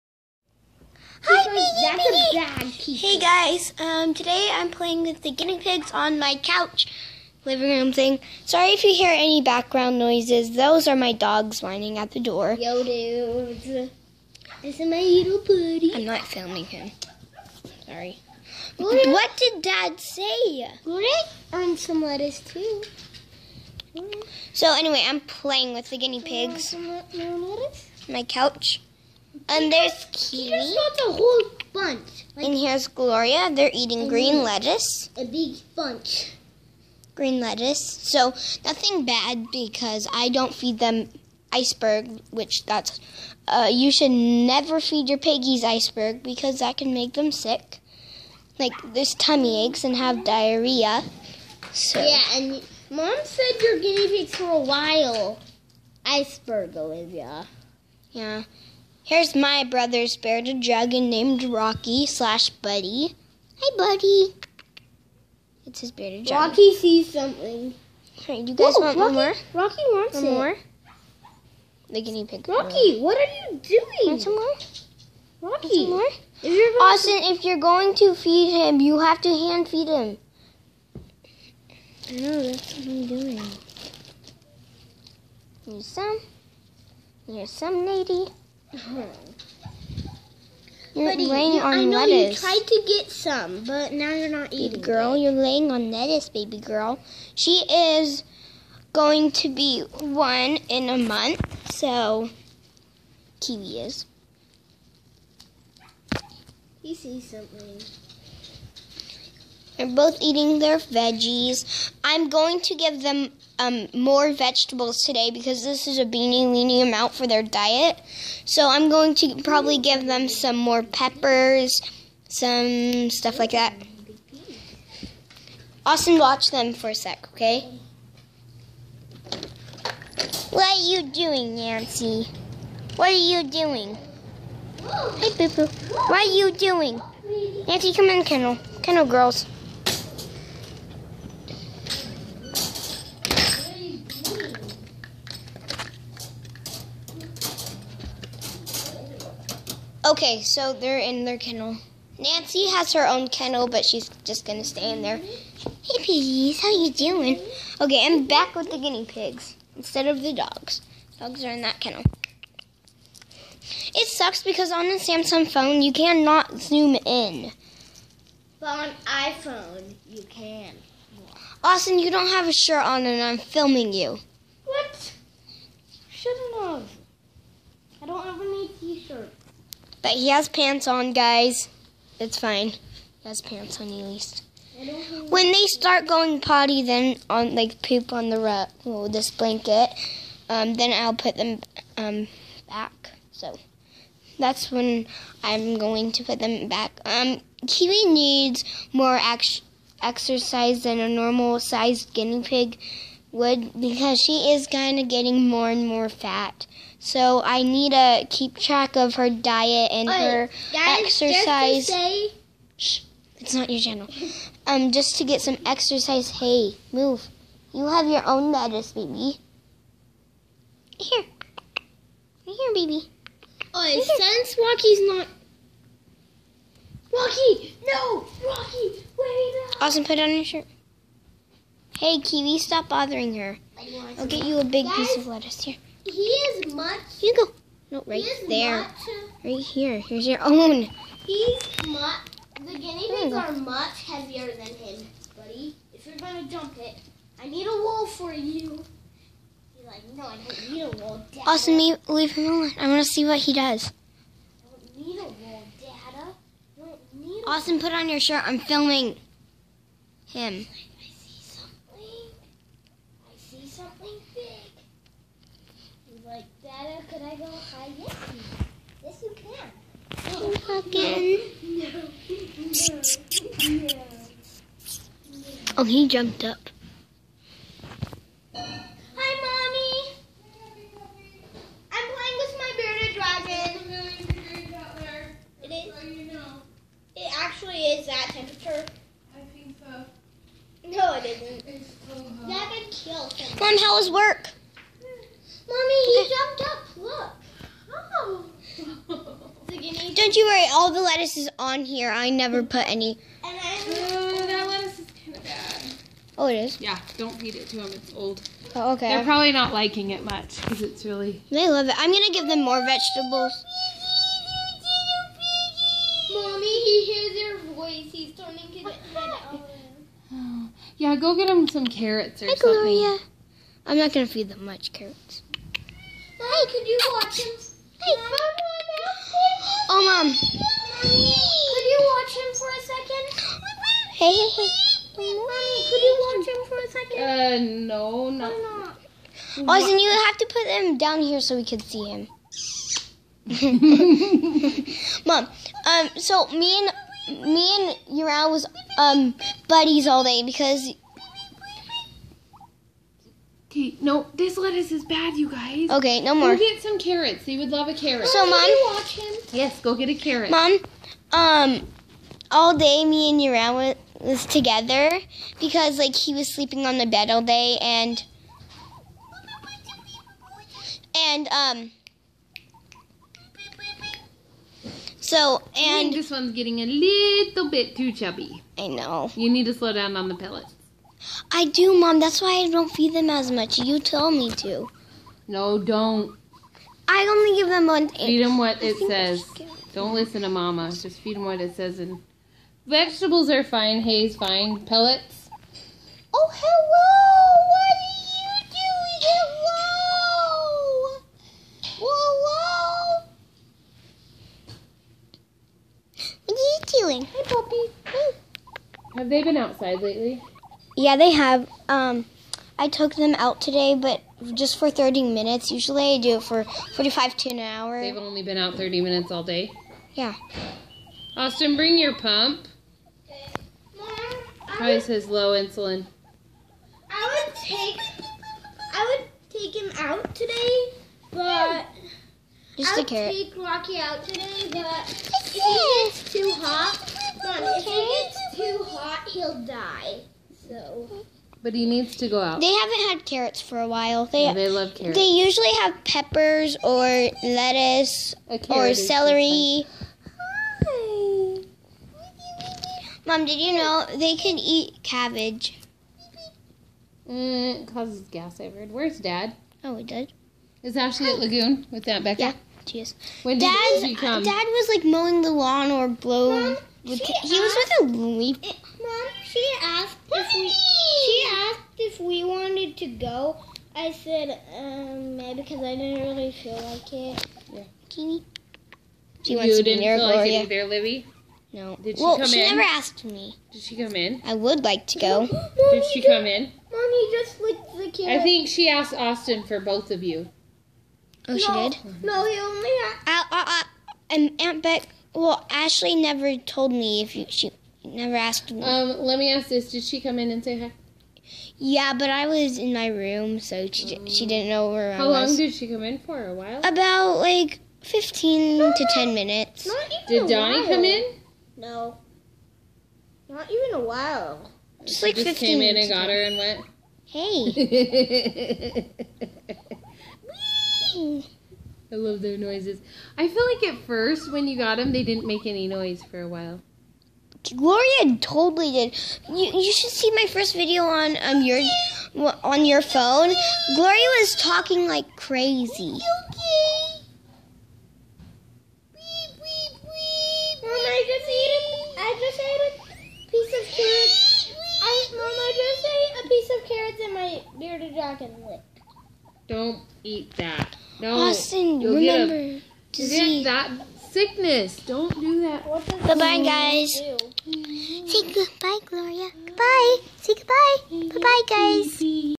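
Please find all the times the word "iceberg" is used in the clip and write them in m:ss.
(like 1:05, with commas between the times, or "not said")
0:41, 0:45, 0:56.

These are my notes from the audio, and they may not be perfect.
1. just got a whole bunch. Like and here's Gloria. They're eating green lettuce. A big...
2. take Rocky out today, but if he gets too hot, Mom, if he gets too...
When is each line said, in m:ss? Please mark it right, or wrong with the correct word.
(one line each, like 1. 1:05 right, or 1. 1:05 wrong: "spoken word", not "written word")
1. 0:30 right
2. 7:13 right.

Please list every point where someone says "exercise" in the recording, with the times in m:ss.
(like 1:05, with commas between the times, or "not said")
3:20, 3:30, 3:35.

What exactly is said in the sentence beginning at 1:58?
So I'm going to probably give them some more peppers, some stuff like that.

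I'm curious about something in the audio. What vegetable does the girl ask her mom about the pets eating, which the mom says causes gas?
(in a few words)
Cabbage.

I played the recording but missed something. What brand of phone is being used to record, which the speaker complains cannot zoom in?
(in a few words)
Samsung.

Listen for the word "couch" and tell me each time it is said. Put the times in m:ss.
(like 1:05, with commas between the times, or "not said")
0:06, 0:28.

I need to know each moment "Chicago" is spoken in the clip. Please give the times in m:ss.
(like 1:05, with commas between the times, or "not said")
not said.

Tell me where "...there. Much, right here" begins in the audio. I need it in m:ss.
3:58.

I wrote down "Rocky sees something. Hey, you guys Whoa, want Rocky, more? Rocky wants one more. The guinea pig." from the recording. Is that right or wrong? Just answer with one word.
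right.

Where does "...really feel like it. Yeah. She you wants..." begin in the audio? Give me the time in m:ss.
7:56.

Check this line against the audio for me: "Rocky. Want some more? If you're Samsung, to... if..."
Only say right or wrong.
wrong.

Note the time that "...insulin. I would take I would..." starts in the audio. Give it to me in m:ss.
7:05.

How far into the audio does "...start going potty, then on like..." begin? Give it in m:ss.
3:05.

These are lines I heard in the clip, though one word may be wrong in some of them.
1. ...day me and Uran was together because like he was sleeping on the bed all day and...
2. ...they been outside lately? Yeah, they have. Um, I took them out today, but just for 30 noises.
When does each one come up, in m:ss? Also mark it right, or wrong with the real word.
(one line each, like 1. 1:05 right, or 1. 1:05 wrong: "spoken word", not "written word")
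1. 6:02 right
2. 6:49 wrong: "minutes", not "noises".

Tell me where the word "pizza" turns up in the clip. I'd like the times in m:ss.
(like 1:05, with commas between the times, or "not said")
0:02.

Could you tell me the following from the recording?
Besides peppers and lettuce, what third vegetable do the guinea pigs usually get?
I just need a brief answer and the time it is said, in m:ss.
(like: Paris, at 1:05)
Celery, at 7:28.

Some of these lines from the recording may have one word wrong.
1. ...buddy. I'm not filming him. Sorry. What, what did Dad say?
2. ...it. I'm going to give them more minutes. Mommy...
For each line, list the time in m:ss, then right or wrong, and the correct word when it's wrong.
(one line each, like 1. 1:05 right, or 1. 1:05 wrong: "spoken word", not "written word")
1. 0:15 right
2. 5:11 wrong: "vegetables", not "minutes".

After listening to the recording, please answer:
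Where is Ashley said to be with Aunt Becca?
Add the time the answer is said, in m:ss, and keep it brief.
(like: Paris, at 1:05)
Lagoon, at 7:41.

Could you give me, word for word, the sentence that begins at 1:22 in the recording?
I know, that's what I'm doing.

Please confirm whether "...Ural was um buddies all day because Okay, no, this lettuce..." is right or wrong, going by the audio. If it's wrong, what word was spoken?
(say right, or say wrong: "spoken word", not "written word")
right.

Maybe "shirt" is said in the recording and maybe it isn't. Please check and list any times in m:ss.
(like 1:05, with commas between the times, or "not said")
2:52, 2:58, 3:50, 4:18.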